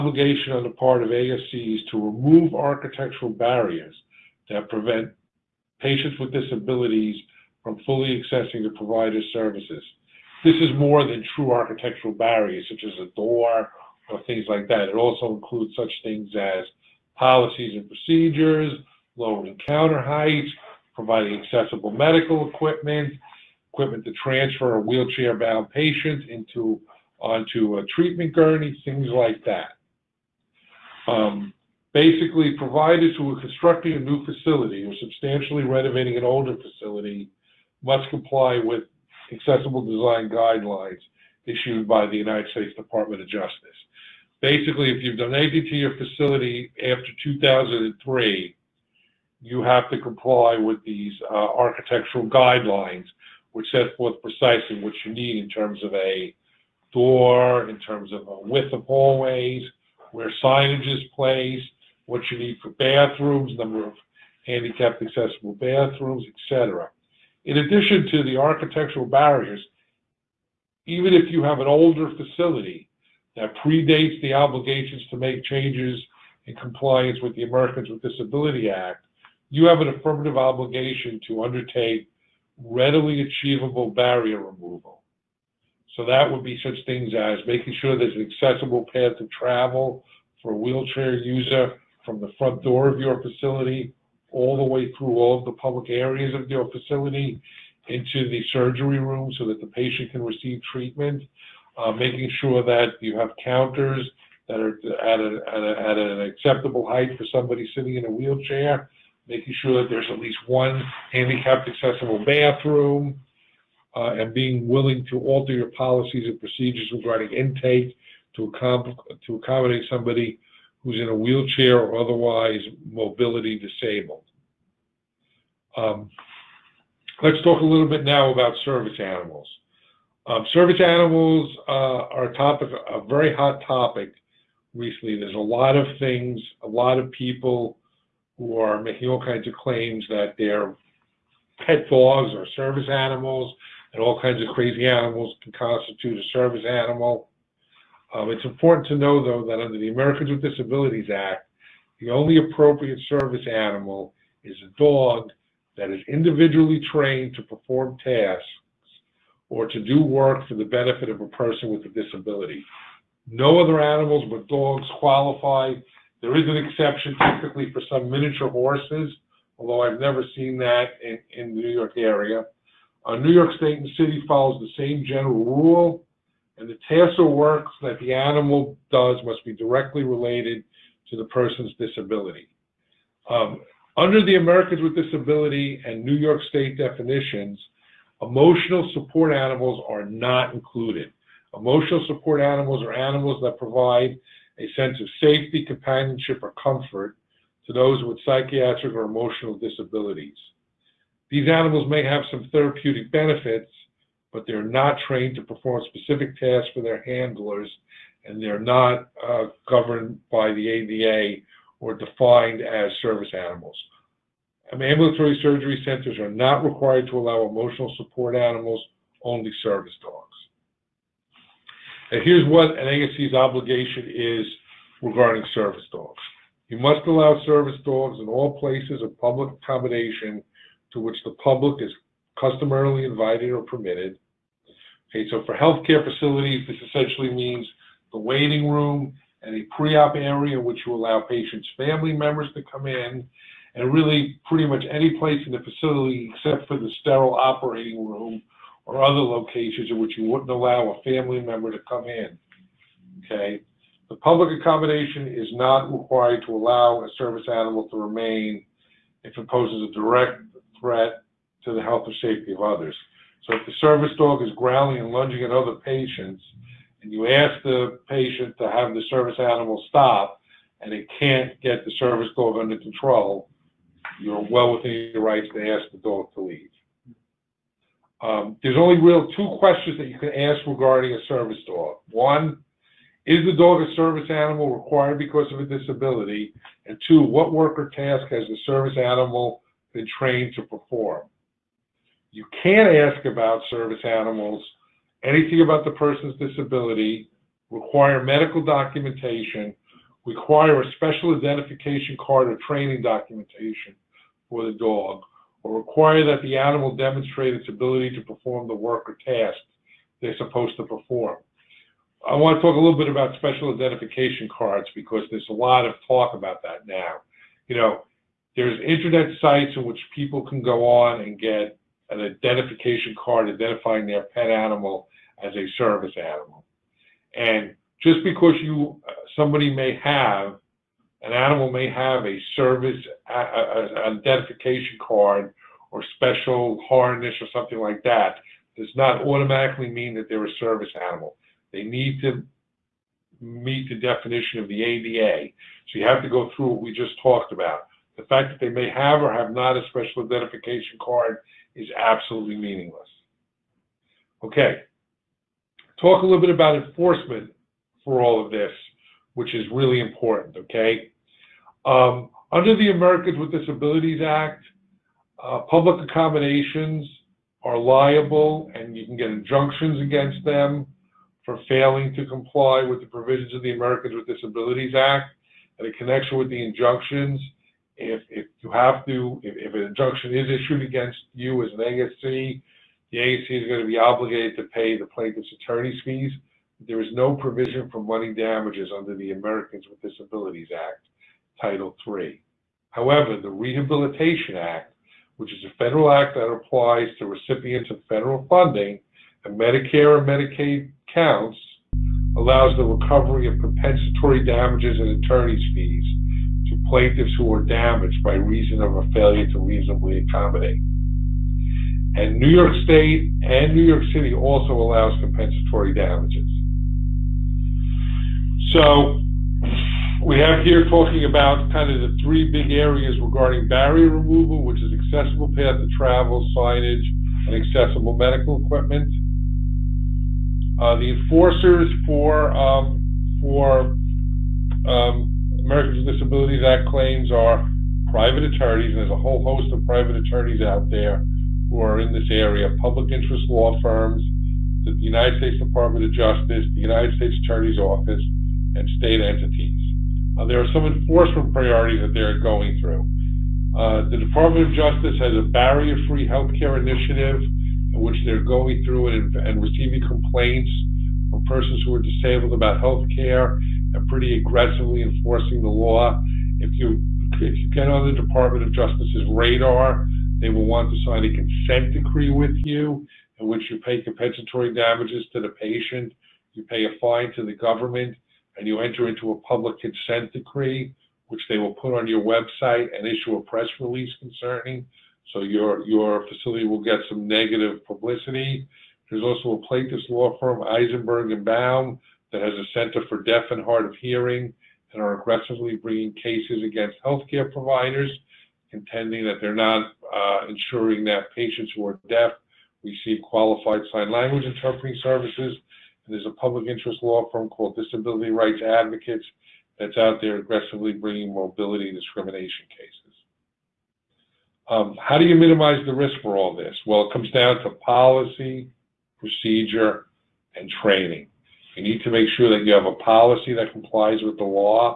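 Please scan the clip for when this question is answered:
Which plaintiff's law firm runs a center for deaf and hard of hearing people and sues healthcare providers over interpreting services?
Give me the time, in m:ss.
8:10.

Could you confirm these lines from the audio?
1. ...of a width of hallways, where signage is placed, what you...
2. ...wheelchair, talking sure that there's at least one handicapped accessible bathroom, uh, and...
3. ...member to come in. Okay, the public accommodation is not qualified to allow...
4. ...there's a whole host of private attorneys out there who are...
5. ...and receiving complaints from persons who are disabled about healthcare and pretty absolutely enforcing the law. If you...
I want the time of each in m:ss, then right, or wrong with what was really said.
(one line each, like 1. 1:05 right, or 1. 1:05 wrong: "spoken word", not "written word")
1. 0:58 right
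2. 1:48 wrong: "making", not "talking"
3. 4:11 wrong: "required", not "qualified"
4. 7:18 right
5. 7:39 wrong: "aggressively", not "absolutely".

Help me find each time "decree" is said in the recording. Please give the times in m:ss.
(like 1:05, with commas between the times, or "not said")
7:51, 8:00.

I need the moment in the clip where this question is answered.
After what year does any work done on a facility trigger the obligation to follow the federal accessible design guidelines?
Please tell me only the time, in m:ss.
0:47.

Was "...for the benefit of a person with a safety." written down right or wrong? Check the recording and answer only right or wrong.
wrong.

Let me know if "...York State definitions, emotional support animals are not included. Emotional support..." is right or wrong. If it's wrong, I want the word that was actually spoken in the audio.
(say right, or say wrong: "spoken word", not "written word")
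right.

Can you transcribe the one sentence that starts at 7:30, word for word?
Uh, there are some enforcement priorities that they're going through.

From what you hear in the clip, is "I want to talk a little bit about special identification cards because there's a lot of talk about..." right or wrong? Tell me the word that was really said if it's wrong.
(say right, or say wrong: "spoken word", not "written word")
right.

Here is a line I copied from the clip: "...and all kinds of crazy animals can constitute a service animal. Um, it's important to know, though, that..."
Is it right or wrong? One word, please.
right.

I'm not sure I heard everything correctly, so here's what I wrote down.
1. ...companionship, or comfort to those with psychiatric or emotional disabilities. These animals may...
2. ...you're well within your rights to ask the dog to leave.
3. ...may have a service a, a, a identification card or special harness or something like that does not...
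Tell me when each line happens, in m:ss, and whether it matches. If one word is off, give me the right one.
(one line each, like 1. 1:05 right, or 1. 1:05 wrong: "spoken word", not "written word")
1. 3:15 right
2. 4:34 right
3. 5:31 right.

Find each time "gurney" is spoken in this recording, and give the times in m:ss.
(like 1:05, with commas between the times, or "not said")
0:28.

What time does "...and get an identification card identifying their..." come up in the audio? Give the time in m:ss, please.
5:21.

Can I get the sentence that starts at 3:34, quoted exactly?
Um, ambulatory surgery centers are not required to allow emotional support animals, only service dogs.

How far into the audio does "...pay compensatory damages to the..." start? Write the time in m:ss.
7:53.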